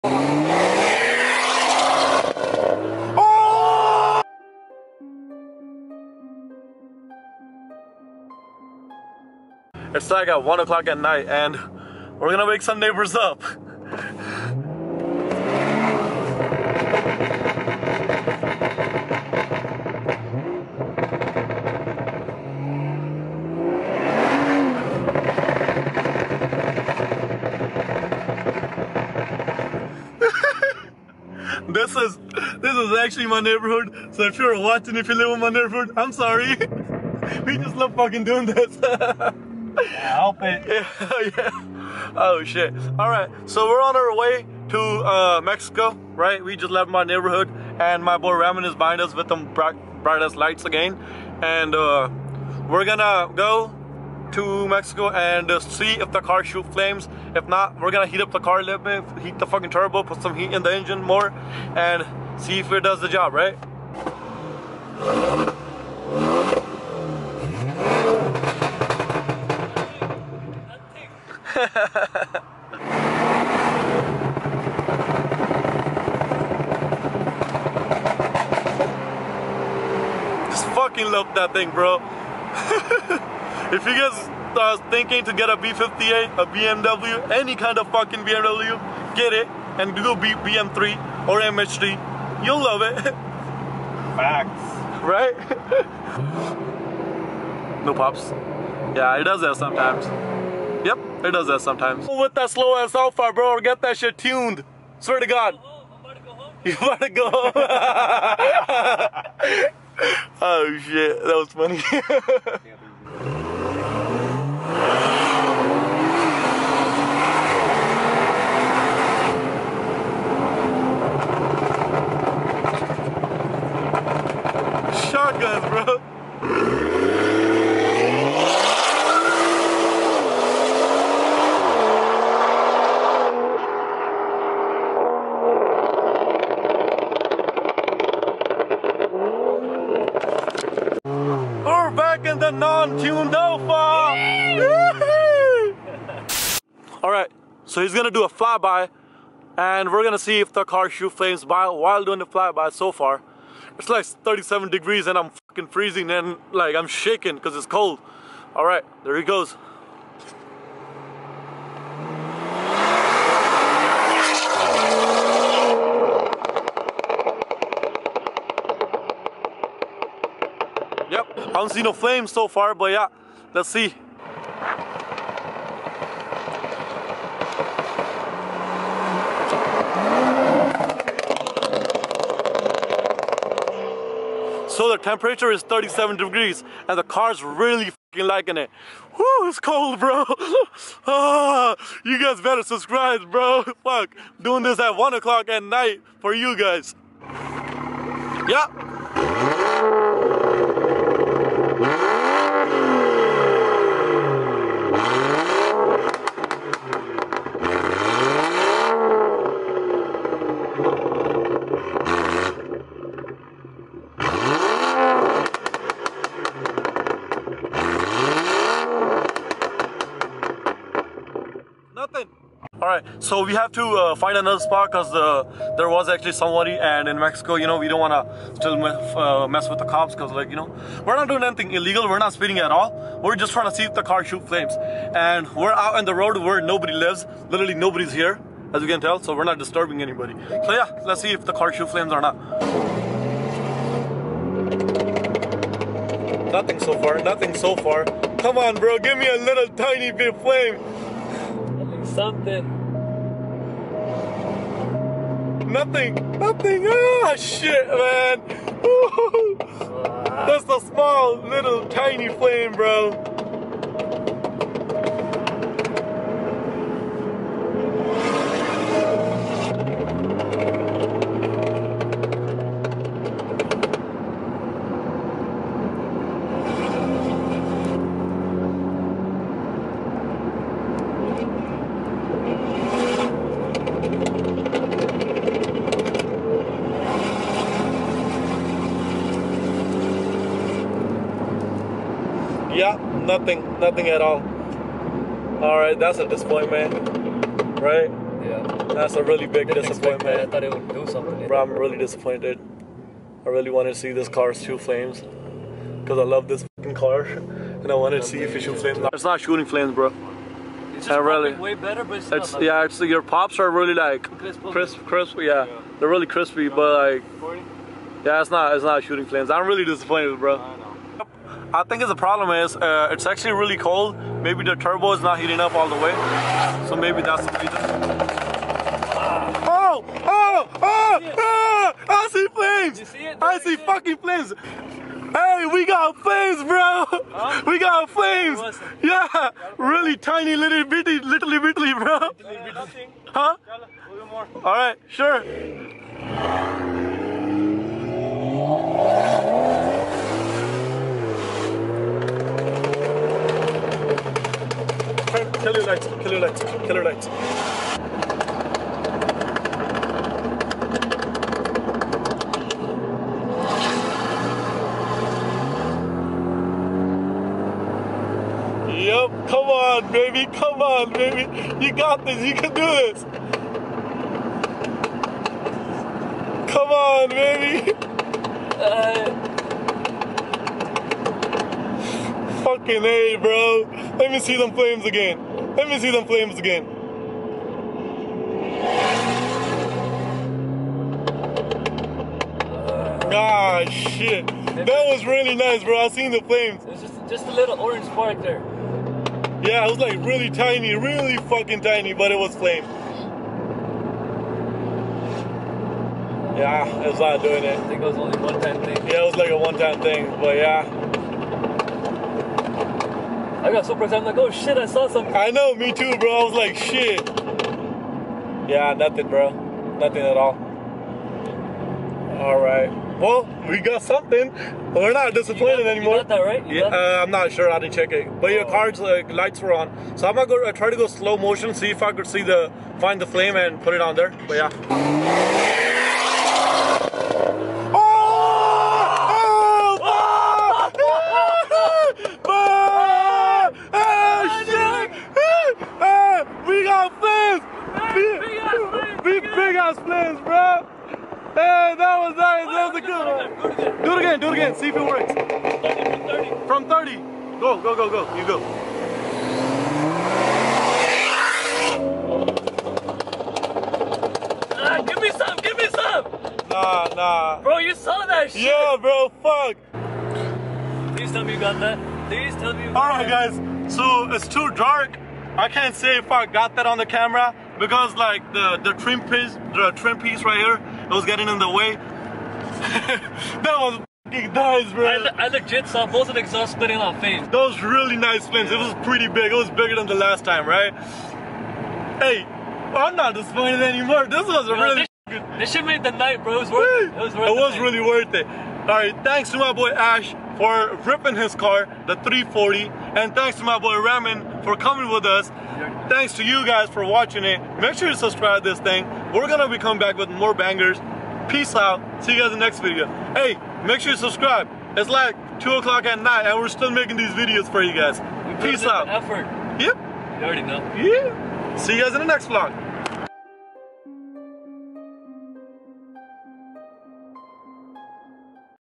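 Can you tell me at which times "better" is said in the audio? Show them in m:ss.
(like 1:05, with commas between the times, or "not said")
3:12, 5:11.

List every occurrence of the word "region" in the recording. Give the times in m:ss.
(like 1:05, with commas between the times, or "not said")
not said.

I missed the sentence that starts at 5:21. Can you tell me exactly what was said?
I think the problem is uh, it's actually really cold.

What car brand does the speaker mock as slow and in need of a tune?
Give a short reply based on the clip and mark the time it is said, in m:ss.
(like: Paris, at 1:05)
Alfa, at 1:42.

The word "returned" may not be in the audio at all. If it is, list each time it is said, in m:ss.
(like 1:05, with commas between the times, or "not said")
not said.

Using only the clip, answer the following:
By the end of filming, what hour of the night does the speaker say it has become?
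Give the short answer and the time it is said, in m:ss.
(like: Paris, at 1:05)
2 o'clock, at 8:35.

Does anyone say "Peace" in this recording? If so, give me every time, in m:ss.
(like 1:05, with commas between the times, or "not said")
8:31, 8:38.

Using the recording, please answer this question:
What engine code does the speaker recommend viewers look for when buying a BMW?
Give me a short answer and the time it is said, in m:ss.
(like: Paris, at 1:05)
B58, at 1:25.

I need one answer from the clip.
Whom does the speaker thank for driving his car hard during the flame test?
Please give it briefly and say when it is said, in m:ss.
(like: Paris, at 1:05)
Ash, at 8:19.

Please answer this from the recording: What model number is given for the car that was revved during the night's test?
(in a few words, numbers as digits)
340.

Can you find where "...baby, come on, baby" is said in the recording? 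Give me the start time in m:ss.
6:10.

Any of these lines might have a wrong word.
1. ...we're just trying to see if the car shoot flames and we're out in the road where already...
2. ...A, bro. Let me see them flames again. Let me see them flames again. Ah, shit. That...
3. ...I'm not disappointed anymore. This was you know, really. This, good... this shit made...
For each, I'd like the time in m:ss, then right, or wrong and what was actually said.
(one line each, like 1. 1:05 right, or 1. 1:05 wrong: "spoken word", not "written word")
1. 3:53 wrong: "nobody", not "already"
2. 6:23 right
3. 8:12 right.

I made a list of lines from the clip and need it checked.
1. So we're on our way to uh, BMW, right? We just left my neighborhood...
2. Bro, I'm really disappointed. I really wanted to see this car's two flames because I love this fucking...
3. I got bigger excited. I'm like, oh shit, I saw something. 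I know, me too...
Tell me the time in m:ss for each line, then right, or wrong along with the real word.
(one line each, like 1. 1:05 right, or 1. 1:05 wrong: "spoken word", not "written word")
1. 0:43 wrong: "Mexico", not "BMW"
2. 5:01 right
3. 6:53 wrong: "super", not "bigger".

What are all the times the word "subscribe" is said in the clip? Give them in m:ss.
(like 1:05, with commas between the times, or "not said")
3:12, 8:28, 8:34.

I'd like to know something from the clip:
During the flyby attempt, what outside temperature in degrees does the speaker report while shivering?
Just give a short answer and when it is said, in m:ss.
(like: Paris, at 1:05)
37 degrees, at 2:33.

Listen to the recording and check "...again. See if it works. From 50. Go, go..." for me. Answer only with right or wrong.
wrong.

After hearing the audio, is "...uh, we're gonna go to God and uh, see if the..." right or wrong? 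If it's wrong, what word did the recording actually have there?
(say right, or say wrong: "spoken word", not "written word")
wrong: "Mexico", not "God".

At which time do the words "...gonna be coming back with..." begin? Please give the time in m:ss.
8:29.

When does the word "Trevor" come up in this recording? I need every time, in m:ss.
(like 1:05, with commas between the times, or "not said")
not said.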